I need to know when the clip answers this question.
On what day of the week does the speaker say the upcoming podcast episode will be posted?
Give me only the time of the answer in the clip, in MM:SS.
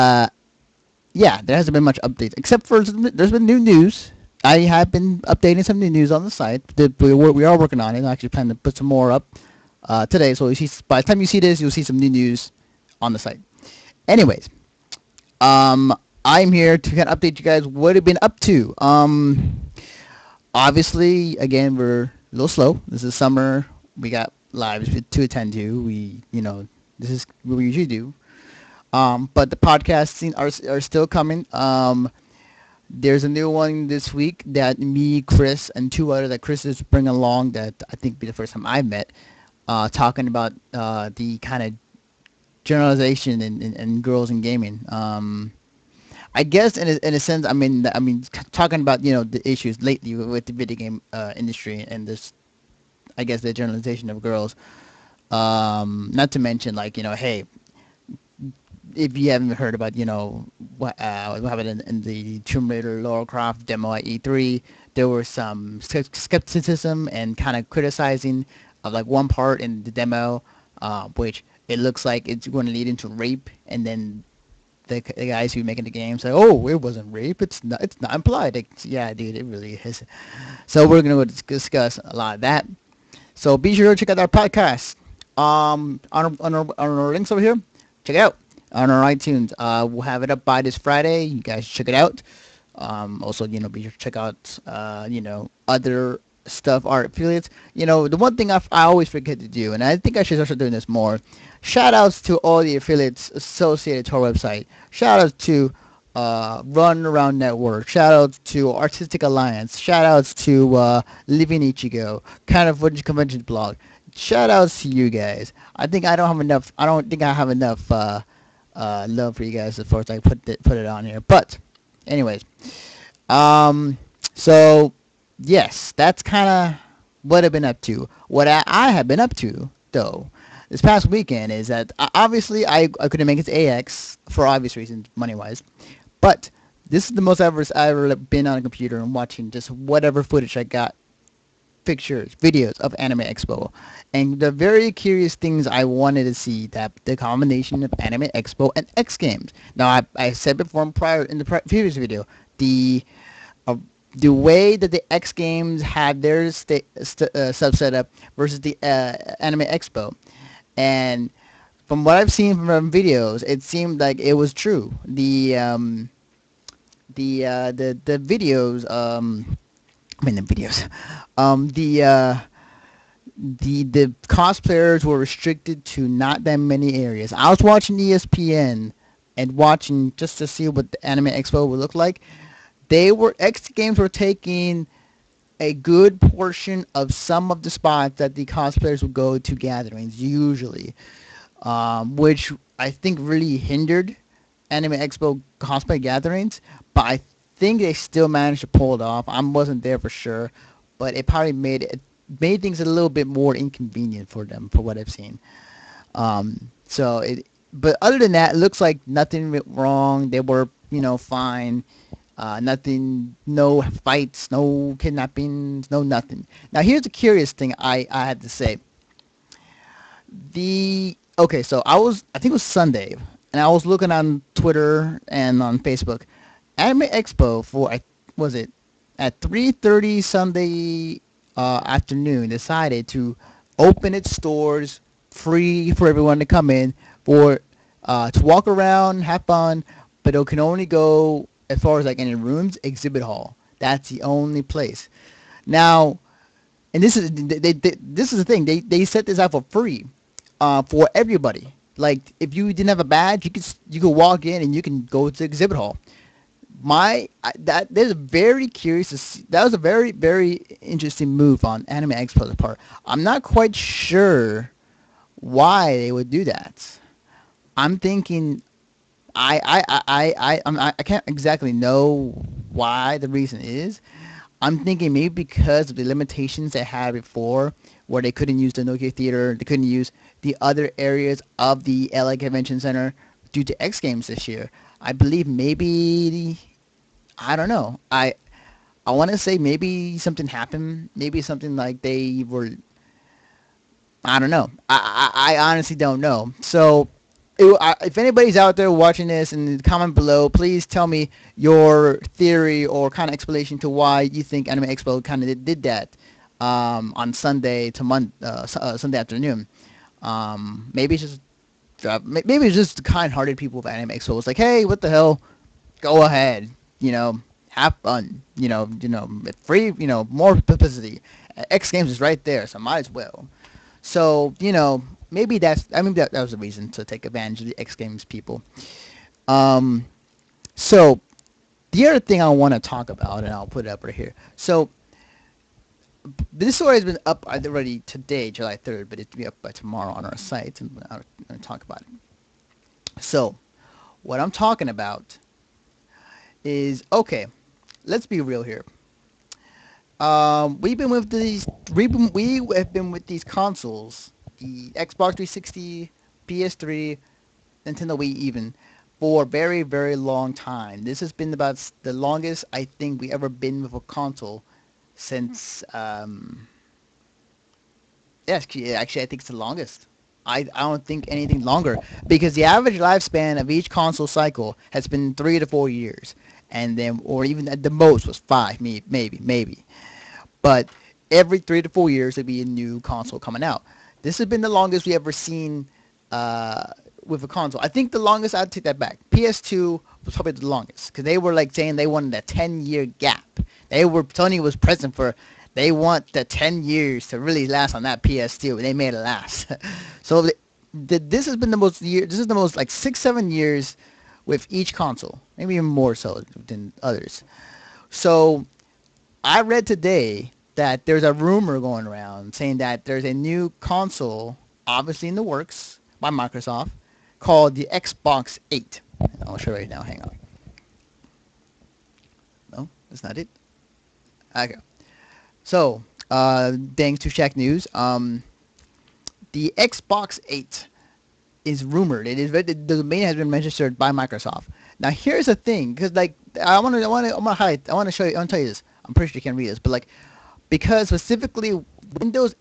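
01:30.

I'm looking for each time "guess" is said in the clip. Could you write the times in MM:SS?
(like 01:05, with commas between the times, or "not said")
00:46, 00:53.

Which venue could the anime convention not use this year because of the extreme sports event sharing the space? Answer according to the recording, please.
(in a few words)
Nokia Theater.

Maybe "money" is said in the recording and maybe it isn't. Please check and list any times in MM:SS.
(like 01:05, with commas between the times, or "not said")
02:15.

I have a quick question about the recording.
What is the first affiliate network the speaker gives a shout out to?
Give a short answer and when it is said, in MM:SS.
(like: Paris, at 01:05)
Run Around Network, at 01:46.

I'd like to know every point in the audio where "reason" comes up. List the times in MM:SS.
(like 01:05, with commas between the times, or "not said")
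02:14, 04:33, 05:26.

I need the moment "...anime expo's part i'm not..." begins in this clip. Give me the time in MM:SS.
04:21.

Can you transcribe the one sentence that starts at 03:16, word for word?
But I think they still managed to pull it off.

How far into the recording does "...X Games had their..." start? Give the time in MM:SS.
02:35.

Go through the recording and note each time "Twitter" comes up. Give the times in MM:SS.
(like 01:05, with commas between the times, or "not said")
03:44.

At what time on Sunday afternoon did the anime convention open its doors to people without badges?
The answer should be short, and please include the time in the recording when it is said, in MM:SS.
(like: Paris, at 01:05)
3:30, at 03:49.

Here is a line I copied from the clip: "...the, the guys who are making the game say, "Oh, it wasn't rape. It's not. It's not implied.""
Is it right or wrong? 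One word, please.
right.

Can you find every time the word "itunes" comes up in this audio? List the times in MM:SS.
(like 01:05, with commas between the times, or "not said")
01:29.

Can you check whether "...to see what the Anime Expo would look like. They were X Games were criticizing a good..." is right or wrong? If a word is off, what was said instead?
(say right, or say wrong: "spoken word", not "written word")
wrong: "taking", not "criticizing".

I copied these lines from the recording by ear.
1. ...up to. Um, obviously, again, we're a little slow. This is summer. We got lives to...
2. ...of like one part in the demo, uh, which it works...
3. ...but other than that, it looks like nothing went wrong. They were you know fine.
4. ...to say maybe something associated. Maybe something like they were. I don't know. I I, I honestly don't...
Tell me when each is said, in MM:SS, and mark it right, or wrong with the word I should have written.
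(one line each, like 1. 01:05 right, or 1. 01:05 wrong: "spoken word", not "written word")
1. 00:18 right
2. 01:08 wrong: "looks", not "works"
3. 03:27 right
4. 04:49 wrong: "happened", not "associated".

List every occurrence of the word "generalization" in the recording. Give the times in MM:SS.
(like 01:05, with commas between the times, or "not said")
00:42, 00:53.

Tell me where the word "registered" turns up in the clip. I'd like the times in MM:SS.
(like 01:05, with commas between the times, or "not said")
07:13.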